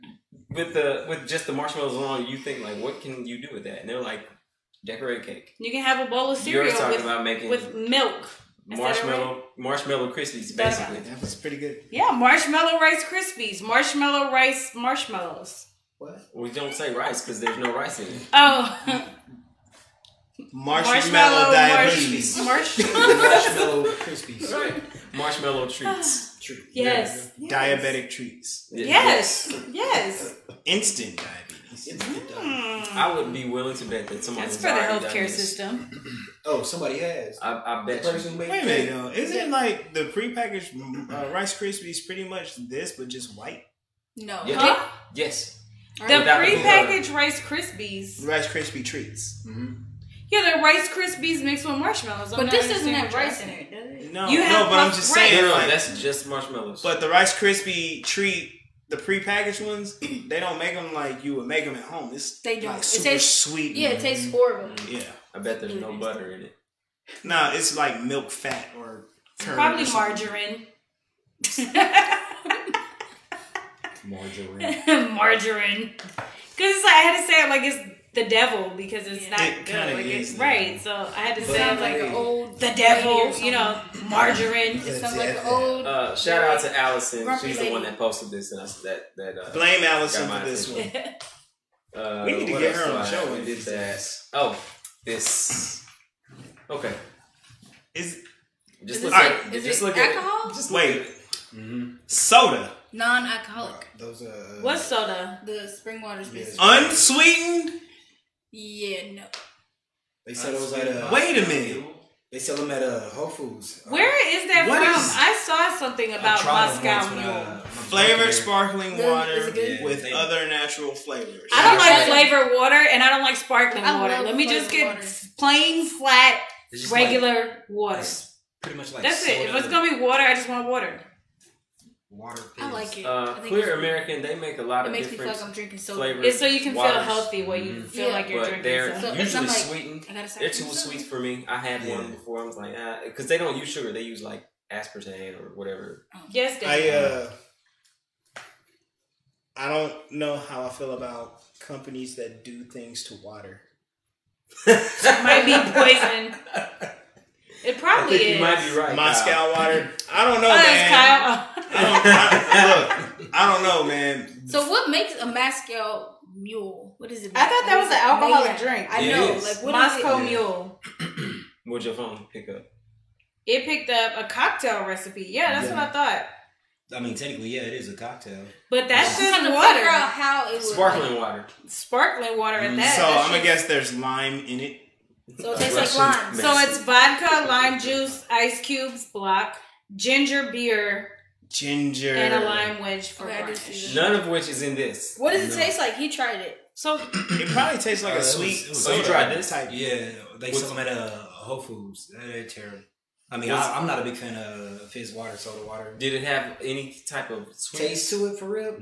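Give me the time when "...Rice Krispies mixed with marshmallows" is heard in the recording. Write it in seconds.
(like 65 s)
50 s.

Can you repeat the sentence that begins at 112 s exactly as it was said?
They sell them at a Whole Foods.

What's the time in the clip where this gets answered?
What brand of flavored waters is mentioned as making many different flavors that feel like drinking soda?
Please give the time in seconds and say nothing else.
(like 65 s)
133 s.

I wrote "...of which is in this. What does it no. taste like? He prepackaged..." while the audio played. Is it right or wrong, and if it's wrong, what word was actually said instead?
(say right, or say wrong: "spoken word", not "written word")
wrong: "tried", not "prepackaged".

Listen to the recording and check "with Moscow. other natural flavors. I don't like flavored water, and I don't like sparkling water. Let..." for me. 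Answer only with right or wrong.
wrong.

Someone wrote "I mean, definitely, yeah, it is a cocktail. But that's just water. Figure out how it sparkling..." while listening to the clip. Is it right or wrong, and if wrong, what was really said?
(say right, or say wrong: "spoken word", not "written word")
wrong: "technically", not "definitely".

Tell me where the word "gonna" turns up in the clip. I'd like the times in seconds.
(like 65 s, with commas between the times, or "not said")
129 s, 183 s.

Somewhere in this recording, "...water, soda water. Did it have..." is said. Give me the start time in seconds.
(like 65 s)
205 s.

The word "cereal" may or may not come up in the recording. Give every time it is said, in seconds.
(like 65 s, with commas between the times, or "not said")
6 s.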